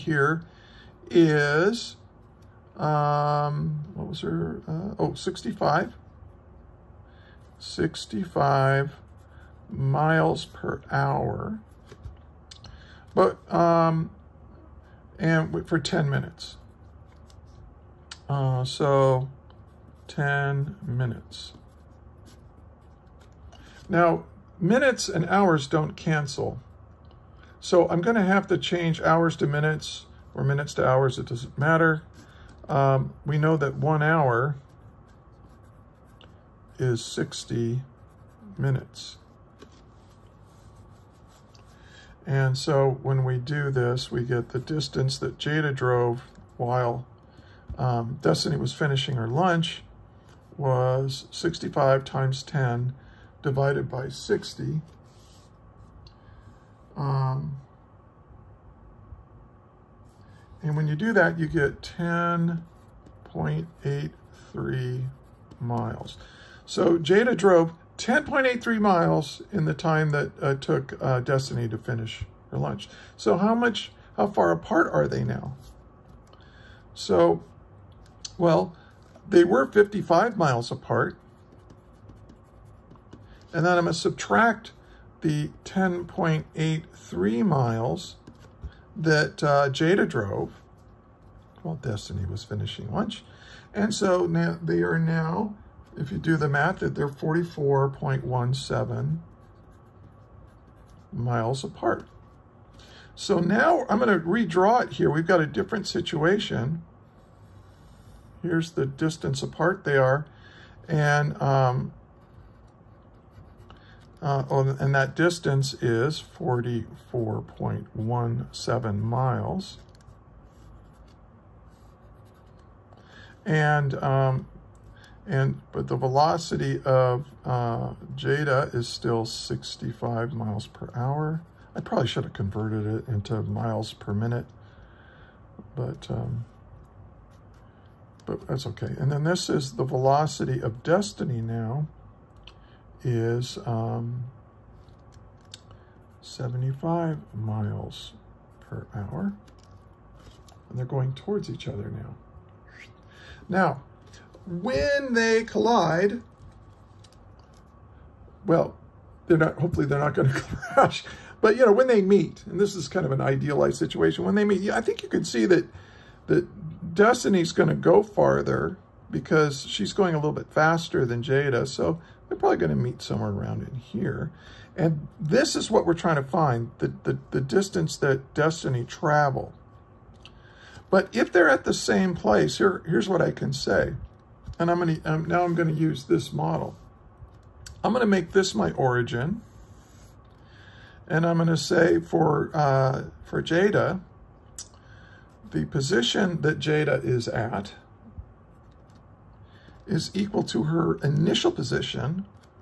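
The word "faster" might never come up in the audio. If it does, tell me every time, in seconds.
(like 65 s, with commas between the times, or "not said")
170 s.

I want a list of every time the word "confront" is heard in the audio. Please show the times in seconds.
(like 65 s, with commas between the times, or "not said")
not said.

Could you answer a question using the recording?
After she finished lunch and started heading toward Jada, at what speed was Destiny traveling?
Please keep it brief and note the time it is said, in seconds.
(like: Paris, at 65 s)
75 miles per hour, at 146 s.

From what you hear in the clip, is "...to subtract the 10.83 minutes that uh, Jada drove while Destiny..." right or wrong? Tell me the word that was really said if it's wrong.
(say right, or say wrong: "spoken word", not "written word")
wrong: "miles", not "minutes".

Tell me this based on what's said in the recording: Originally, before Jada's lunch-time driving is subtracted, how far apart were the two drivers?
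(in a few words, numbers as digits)
55 miles.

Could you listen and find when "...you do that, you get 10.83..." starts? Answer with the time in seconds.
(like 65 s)
60 s.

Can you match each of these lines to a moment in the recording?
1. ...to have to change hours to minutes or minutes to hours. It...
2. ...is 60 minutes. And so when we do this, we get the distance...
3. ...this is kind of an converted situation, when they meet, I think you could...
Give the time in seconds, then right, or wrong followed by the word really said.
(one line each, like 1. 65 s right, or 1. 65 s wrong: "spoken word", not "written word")
1. 28 s right
2. 36 s right
3. 162 s wrong: "idealized", not "converted".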